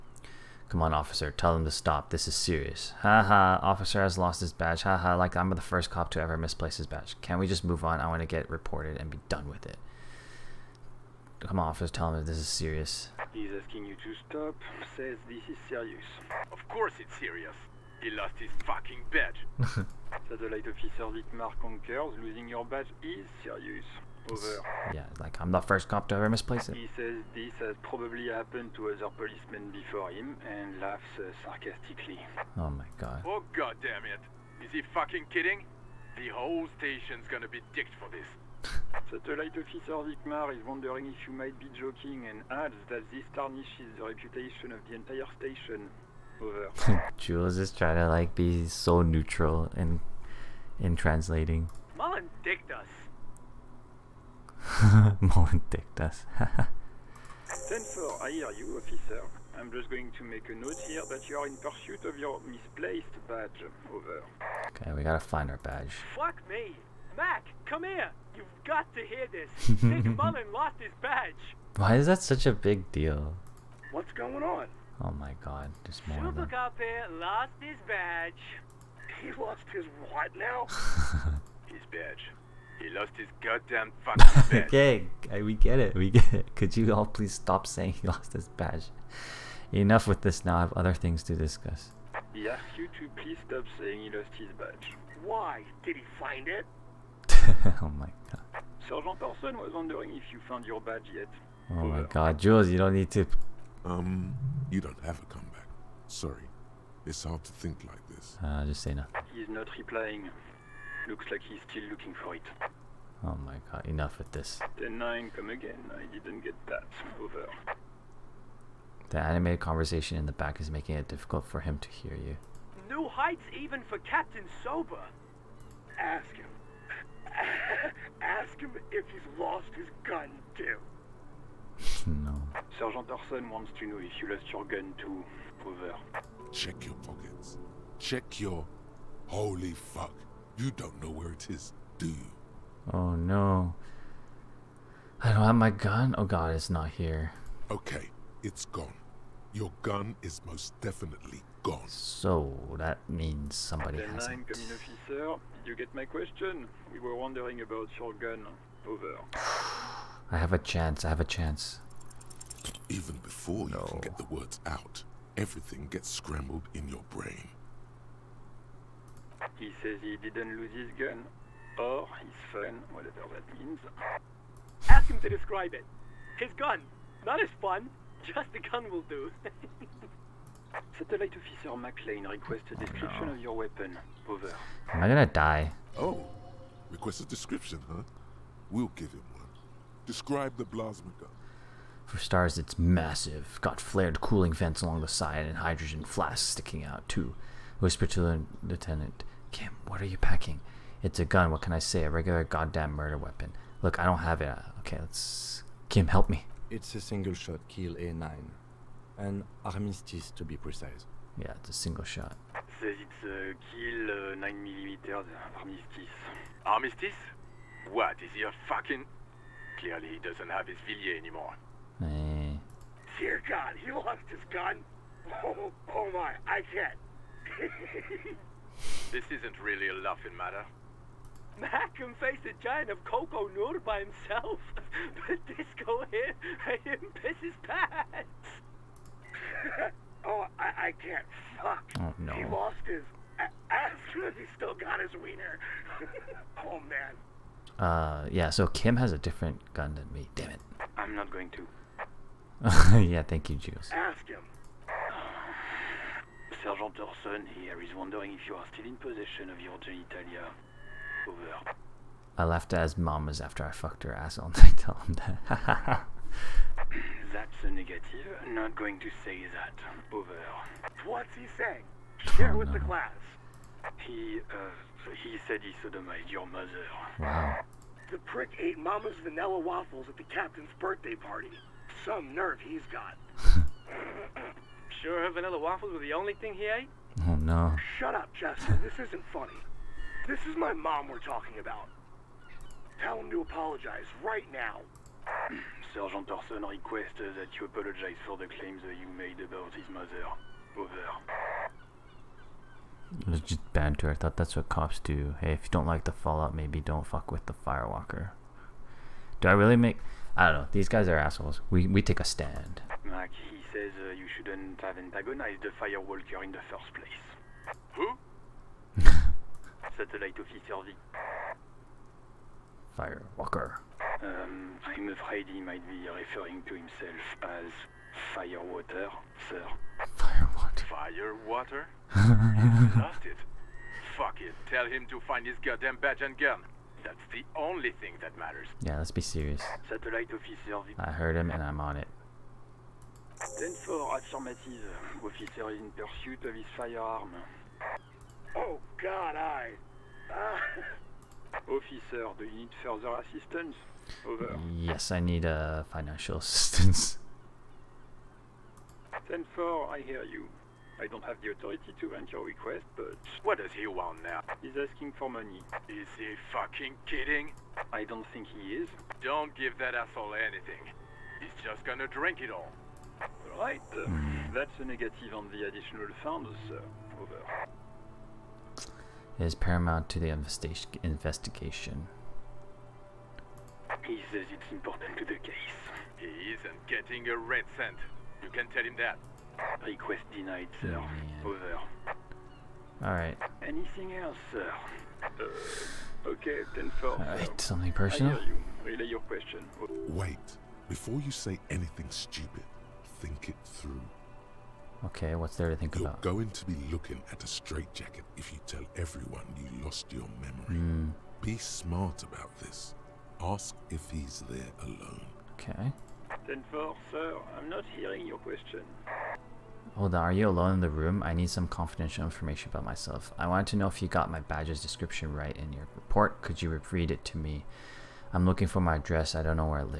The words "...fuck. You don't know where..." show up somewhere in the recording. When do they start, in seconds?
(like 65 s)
139 s.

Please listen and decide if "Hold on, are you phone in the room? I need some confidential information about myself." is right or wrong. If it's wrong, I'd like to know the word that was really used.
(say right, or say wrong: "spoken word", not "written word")
wrong: "alone", not "phone".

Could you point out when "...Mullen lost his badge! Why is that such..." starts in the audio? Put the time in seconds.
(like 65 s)
70 s.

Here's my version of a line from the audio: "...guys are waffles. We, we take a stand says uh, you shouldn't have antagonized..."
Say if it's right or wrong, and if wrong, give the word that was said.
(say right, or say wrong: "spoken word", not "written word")
wrong: "assholes", not "waffles".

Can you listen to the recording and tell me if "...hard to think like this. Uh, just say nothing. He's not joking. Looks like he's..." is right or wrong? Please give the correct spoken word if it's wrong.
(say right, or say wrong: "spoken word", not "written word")
wrong: "replying", not "joking".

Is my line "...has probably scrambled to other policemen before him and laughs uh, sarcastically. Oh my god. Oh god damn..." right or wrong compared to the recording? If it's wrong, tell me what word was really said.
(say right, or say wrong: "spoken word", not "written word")
wrong: "happened", not "scrambled".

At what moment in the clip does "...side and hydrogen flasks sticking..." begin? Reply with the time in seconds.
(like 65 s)
195 s.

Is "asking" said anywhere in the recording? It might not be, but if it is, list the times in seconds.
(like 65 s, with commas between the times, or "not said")
13 s, 364 s.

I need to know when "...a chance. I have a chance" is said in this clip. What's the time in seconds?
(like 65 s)
160 s.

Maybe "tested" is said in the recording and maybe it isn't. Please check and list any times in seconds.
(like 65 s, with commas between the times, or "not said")
not said.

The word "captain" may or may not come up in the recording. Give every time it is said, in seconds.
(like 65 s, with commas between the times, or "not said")
123 s, 280 s.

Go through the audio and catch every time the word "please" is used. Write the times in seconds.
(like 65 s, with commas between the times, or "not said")
87 s, 93 s.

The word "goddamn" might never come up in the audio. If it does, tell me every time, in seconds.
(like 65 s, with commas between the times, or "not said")
83 s, 202 s, 335 s.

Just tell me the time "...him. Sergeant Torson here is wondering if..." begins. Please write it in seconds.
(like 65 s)
254 s.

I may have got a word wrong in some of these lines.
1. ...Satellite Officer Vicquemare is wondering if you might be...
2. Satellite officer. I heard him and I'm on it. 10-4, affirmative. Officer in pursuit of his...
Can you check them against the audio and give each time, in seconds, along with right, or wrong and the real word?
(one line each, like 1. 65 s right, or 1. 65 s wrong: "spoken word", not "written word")
1. 39 s right
2. 339 s right.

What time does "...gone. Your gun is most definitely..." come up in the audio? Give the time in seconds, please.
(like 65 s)
148 s.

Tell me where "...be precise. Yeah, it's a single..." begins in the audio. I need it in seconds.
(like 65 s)
210 s.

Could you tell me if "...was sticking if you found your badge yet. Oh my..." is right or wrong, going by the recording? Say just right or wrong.
wrong.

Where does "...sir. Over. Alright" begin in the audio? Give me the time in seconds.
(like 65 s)
390 s.